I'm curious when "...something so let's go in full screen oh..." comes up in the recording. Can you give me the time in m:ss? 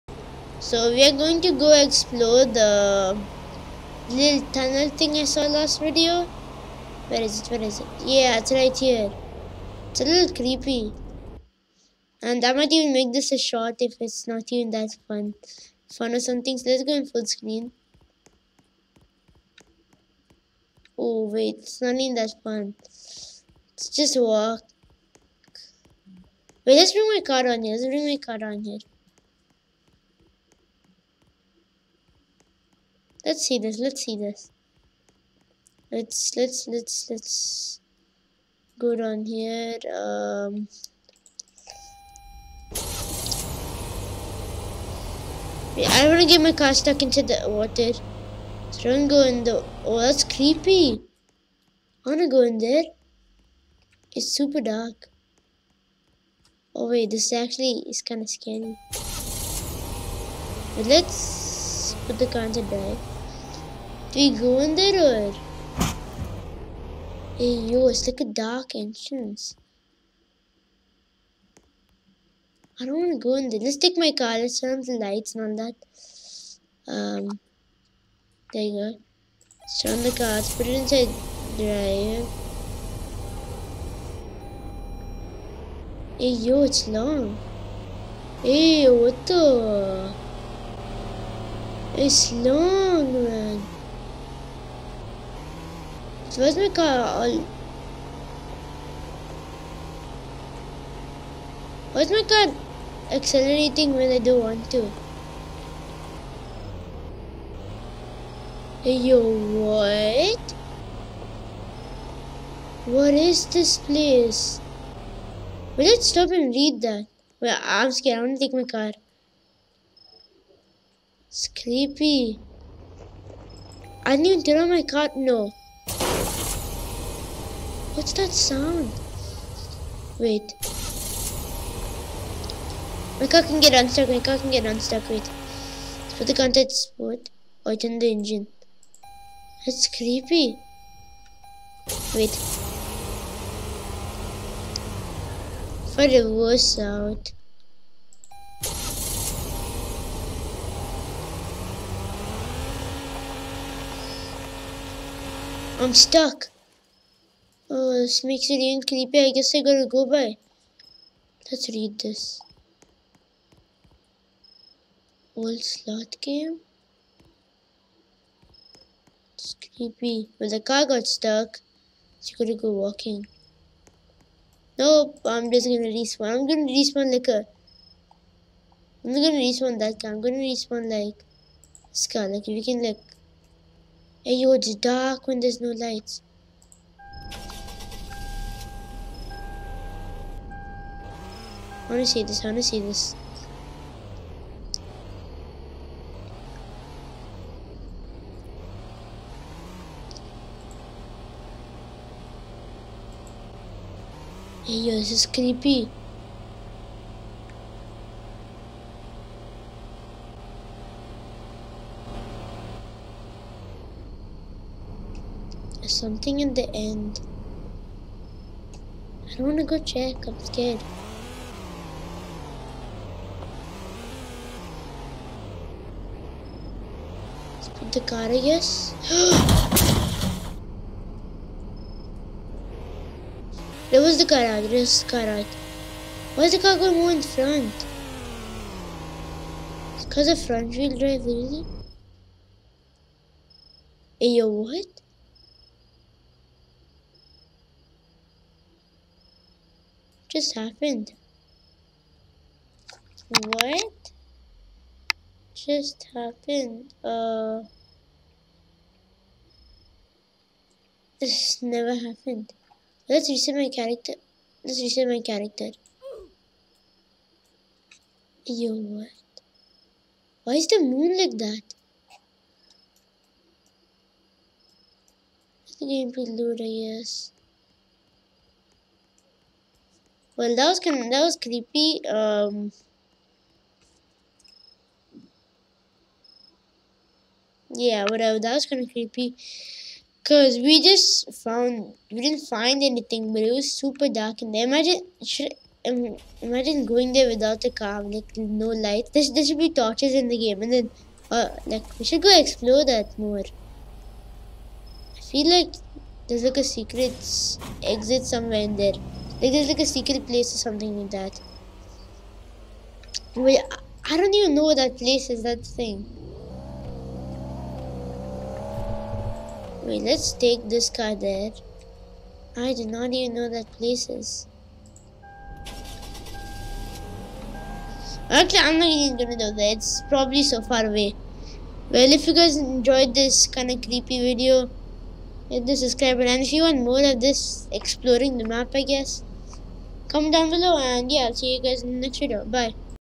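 0:16.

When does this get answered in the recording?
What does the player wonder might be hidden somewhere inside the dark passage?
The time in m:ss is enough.
5:06.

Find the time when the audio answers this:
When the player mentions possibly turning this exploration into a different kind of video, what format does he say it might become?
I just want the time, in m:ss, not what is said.
0:12.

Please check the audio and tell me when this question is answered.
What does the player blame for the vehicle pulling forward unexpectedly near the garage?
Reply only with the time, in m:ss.
4:00.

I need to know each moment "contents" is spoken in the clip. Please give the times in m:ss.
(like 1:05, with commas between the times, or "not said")
2:16.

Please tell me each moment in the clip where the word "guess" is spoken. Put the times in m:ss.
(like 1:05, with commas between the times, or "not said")
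2:39, 3:48, 4:36, 5:38.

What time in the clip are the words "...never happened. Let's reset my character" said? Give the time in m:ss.
4:21.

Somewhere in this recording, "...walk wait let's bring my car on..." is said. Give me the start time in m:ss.
0:24.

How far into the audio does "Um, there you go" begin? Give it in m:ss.
1:16.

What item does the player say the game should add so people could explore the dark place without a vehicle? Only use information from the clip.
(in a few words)
torches.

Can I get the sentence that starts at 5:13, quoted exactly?
Wait, I don't even know what that place is.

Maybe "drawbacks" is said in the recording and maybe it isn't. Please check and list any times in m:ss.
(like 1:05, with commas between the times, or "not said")
not said.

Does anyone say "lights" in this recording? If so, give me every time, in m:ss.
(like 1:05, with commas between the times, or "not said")
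1:14, 3:05, 4:58.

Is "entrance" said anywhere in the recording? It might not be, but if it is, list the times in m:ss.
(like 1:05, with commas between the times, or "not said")
1:08.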